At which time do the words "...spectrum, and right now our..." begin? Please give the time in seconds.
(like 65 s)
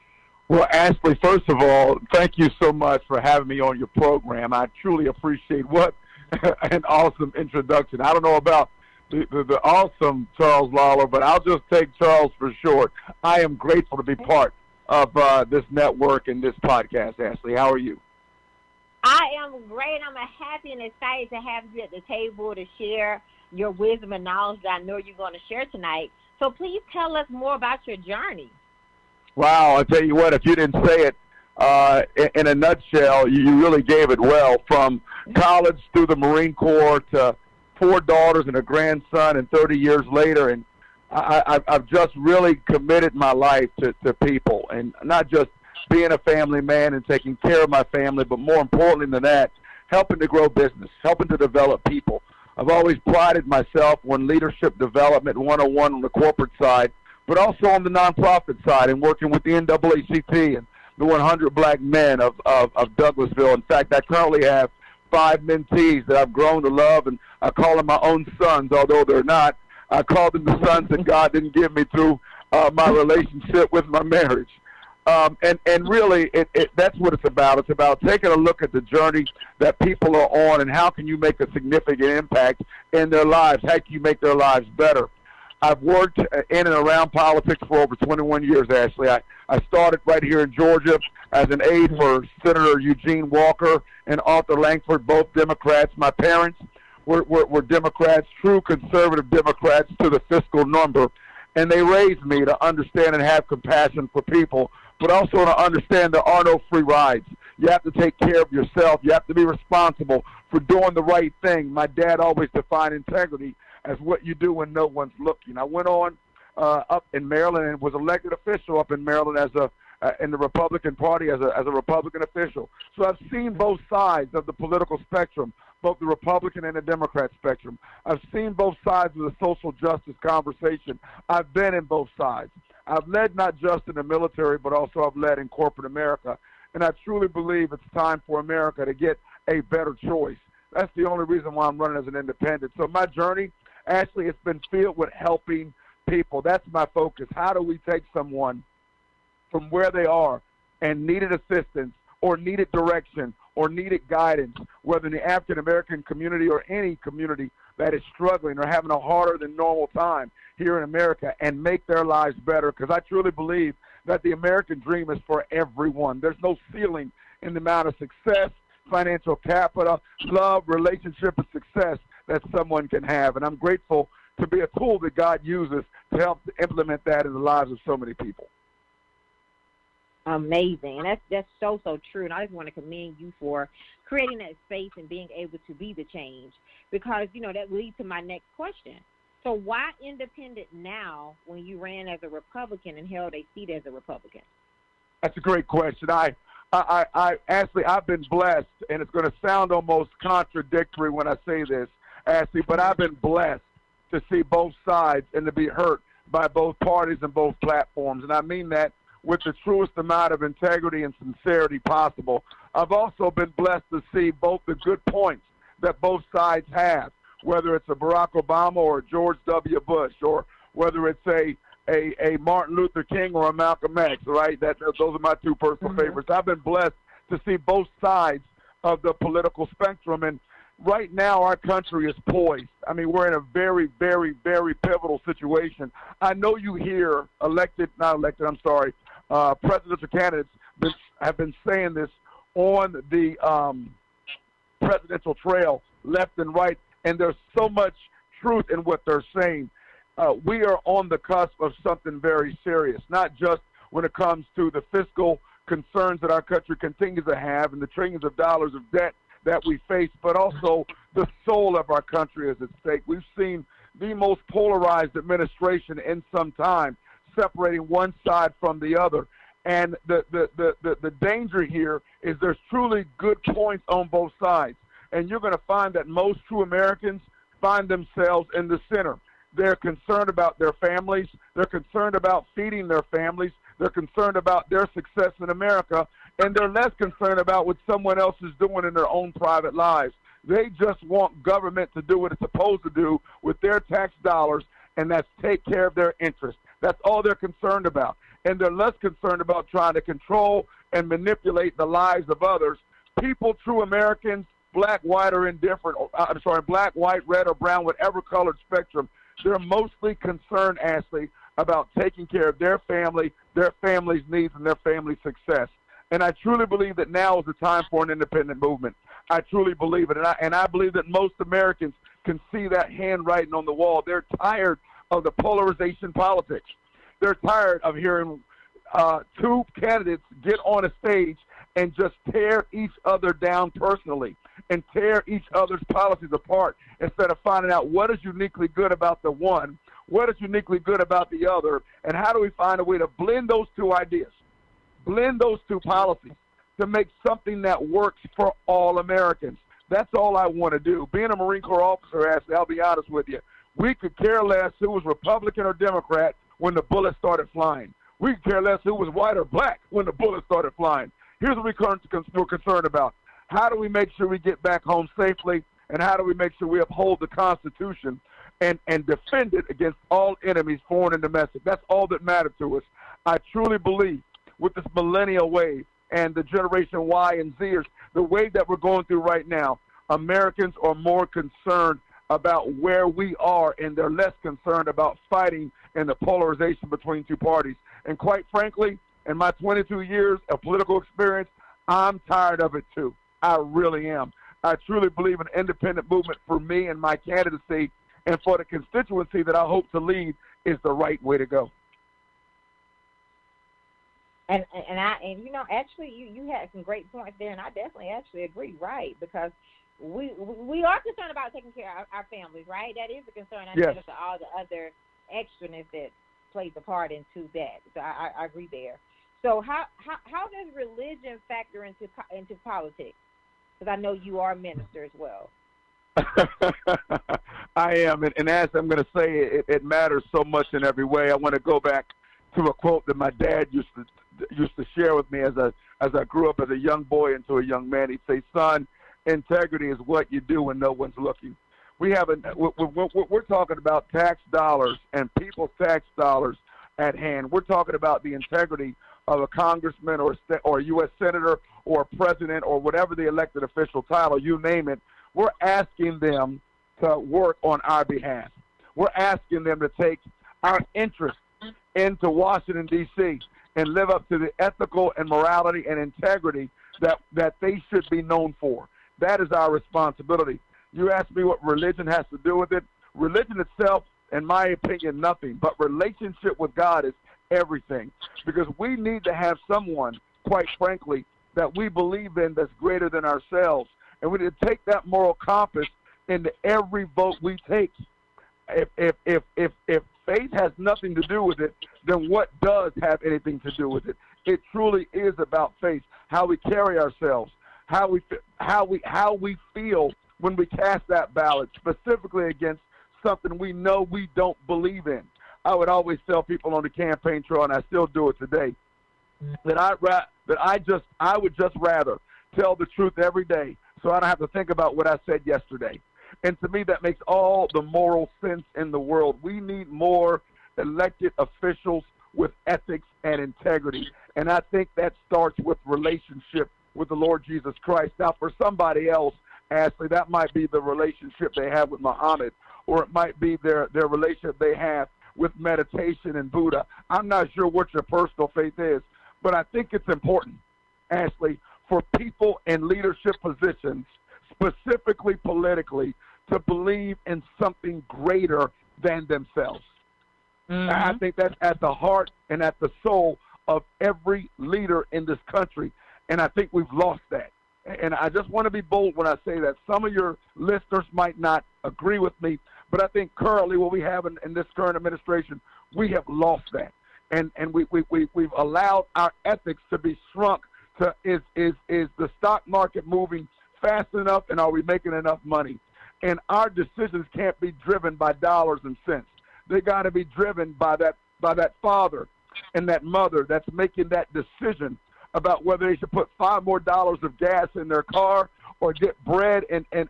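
229 s.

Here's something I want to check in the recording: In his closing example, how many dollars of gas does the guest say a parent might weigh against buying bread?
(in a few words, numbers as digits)
5.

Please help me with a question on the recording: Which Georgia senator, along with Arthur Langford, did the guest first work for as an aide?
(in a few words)
Eugene Walker.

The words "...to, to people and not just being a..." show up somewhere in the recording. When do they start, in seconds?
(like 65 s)
43 s.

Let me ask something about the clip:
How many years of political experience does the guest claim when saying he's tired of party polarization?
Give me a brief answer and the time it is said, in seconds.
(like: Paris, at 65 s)
22, at 389 s.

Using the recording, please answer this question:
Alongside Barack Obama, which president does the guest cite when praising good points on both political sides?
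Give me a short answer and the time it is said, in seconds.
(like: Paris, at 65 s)
George W. Bush, at 219 s.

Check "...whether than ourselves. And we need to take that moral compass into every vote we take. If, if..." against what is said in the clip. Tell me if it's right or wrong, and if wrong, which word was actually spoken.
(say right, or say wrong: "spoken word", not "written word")
wrong: "greater", not "whether".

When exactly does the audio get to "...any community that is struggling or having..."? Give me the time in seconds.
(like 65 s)
156 s.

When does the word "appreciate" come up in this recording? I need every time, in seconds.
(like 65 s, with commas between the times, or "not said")
5 s.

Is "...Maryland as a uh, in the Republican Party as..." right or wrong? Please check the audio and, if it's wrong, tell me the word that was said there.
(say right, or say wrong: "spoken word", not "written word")
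right.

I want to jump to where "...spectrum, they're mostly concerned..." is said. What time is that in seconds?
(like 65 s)
308 s.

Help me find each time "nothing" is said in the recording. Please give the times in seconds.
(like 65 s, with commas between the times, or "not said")
475 s, 490 s.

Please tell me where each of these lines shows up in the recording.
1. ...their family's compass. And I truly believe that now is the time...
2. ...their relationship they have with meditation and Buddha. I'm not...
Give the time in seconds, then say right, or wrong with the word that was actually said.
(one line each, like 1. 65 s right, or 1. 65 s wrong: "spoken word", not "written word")
1. 314 s wrong: "success", not "compass"
2. 533 s right.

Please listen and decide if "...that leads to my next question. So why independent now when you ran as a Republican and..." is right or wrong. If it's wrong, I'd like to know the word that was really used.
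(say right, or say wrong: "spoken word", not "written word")
right.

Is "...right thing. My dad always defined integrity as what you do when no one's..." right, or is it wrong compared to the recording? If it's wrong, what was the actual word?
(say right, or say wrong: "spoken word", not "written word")
right.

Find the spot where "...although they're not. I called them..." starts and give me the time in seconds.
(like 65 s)
68 s.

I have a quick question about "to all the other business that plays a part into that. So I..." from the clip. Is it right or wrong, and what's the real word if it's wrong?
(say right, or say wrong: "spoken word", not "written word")
wrong: "extraness", not "business".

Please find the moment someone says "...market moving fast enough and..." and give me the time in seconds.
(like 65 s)
572 s.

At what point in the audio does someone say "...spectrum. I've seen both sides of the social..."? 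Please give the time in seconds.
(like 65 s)
127 s.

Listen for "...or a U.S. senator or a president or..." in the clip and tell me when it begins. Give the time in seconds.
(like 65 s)
450 s.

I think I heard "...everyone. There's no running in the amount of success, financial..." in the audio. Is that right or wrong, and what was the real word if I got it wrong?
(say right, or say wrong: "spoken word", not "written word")
wrong: "ceiling", not "running".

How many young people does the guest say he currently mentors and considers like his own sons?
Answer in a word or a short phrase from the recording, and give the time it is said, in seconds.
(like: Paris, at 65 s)
5, at 65 s.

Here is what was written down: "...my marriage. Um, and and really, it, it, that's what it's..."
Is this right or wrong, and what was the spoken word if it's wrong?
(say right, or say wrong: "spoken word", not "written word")
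right.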